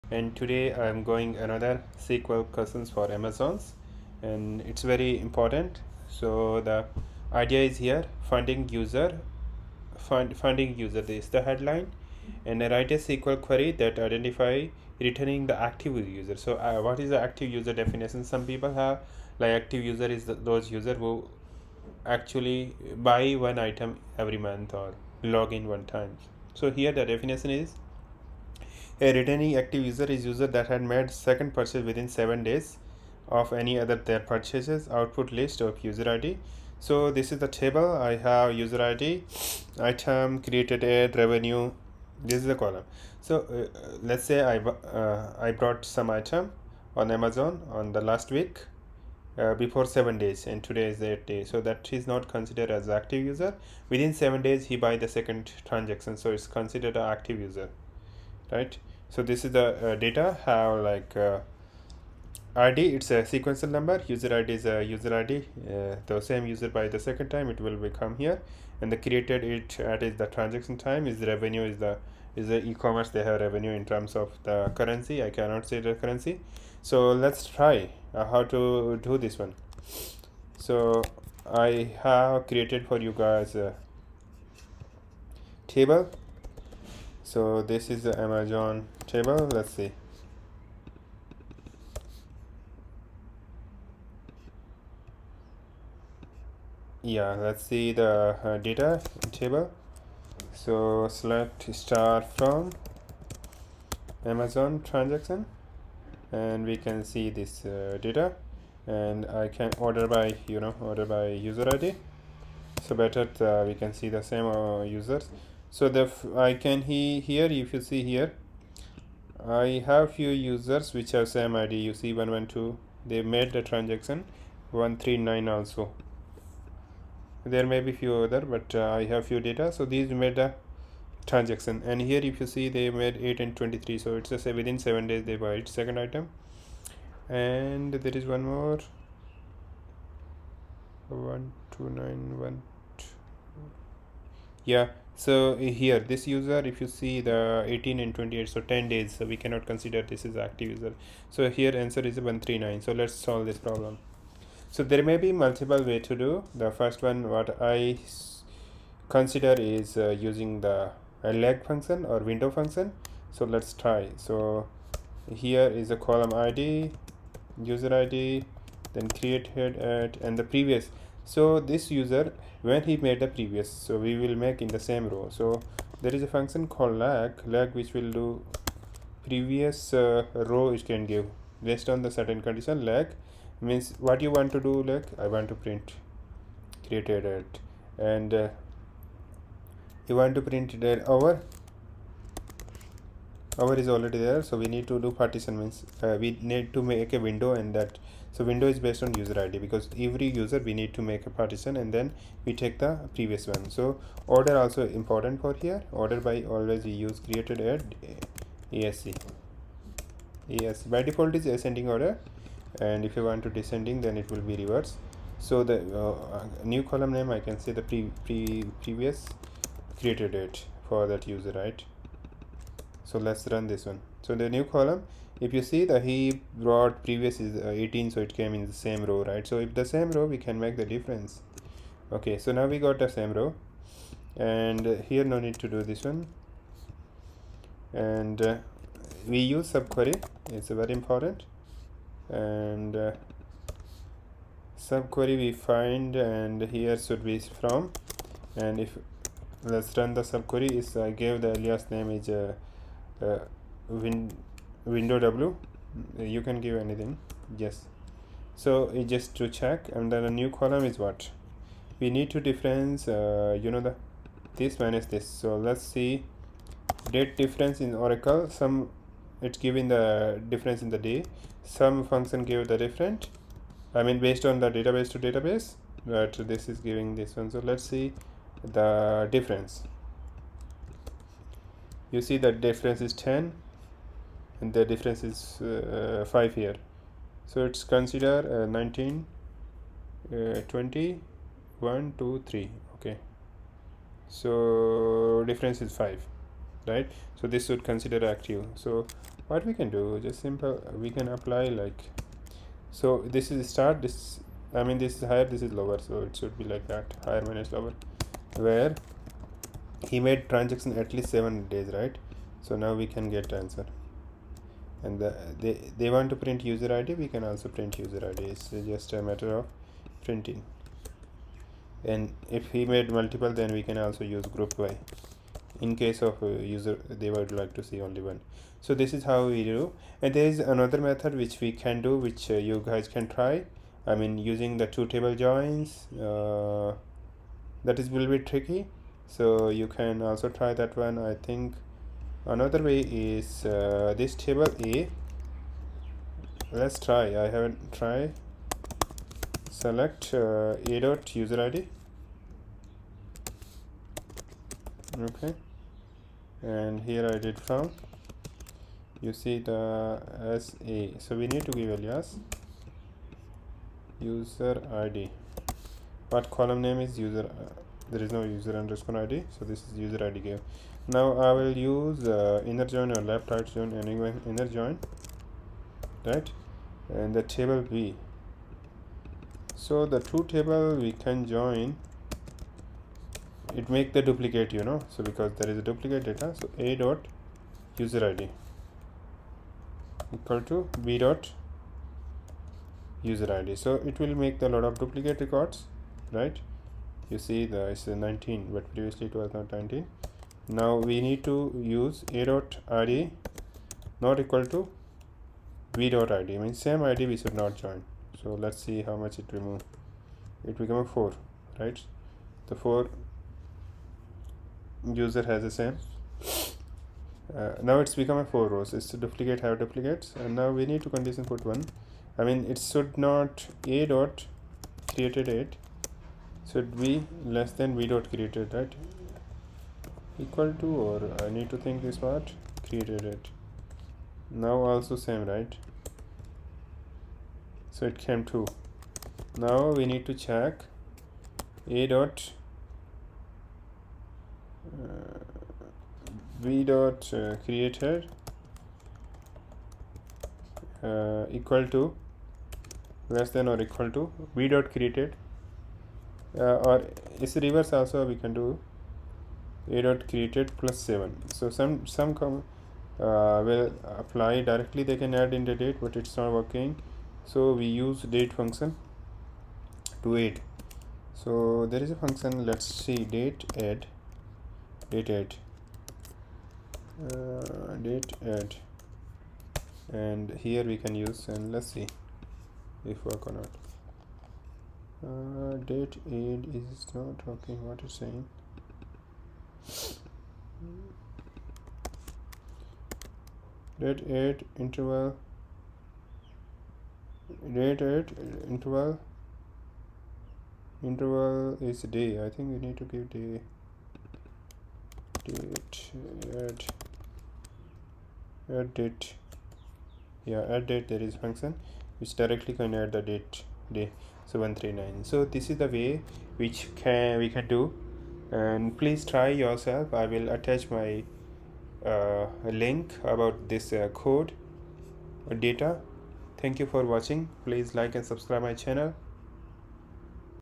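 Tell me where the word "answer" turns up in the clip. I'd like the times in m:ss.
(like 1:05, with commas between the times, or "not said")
2:31, 5:13.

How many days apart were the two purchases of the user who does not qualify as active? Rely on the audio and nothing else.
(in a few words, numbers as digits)
10.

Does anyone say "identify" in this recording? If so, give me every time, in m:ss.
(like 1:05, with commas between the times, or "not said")
0:13.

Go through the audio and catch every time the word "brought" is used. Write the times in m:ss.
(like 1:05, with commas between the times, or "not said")
0:45, 3:46.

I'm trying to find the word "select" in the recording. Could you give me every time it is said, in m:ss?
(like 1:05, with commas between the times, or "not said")
1:41, 5:49.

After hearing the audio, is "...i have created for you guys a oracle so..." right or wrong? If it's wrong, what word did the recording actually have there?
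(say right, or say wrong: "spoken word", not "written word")
wrong: "table", not "oracle".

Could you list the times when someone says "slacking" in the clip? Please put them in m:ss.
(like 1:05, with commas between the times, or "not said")
not said.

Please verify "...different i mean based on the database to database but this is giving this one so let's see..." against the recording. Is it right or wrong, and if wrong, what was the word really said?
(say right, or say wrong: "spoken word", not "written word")
right.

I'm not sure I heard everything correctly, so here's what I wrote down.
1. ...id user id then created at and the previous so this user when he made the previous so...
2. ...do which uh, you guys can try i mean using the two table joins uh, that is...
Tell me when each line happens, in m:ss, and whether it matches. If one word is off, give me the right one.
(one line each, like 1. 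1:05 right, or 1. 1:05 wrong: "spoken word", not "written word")
1. 2:46 right
2. 5:32 right.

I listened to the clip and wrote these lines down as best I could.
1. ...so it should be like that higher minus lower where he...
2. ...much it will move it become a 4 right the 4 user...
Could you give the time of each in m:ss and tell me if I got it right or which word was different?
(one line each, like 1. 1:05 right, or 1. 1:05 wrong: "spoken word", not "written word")
1. 5:06 right
2. 6:49 right.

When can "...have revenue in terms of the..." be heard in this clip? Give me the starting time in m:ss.
1:13.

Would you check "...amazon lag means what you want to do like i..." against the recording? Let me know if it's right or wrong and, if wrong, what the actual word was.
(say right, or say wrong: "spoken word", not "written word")
wrong: "condition", not "amazon".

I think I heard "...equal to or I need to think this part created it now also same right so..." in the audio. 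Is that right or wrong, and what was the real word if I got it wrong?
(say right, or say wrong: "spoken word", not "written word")
right.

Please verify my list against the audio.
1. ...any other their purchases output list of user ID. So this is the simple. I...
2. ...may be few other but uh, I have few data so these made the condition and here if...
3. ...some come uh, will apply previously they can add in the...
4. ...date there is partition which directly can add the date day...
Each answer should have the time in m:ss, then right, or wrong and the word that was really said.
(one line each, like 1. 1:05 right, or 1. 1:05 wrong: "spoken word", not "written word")
1. 0:33 wrong: "table", not "simple"
2. 2:07 wrong: "transaction", not "condition"
3. 7:42 wrong: "directly", not "previously"
4. 8:30 wrong: "function", not "partition".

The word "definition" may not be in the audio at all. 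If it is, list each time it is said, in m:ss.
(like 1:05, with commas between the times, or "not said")
0:17, 0:27.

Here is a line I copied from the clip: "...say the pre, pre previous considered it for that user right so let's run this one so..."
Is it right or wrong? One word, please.
wrong.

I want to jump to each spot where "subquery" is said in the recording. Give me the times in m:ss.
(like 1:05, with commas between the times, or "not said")
3:59, 4:04, 4:10.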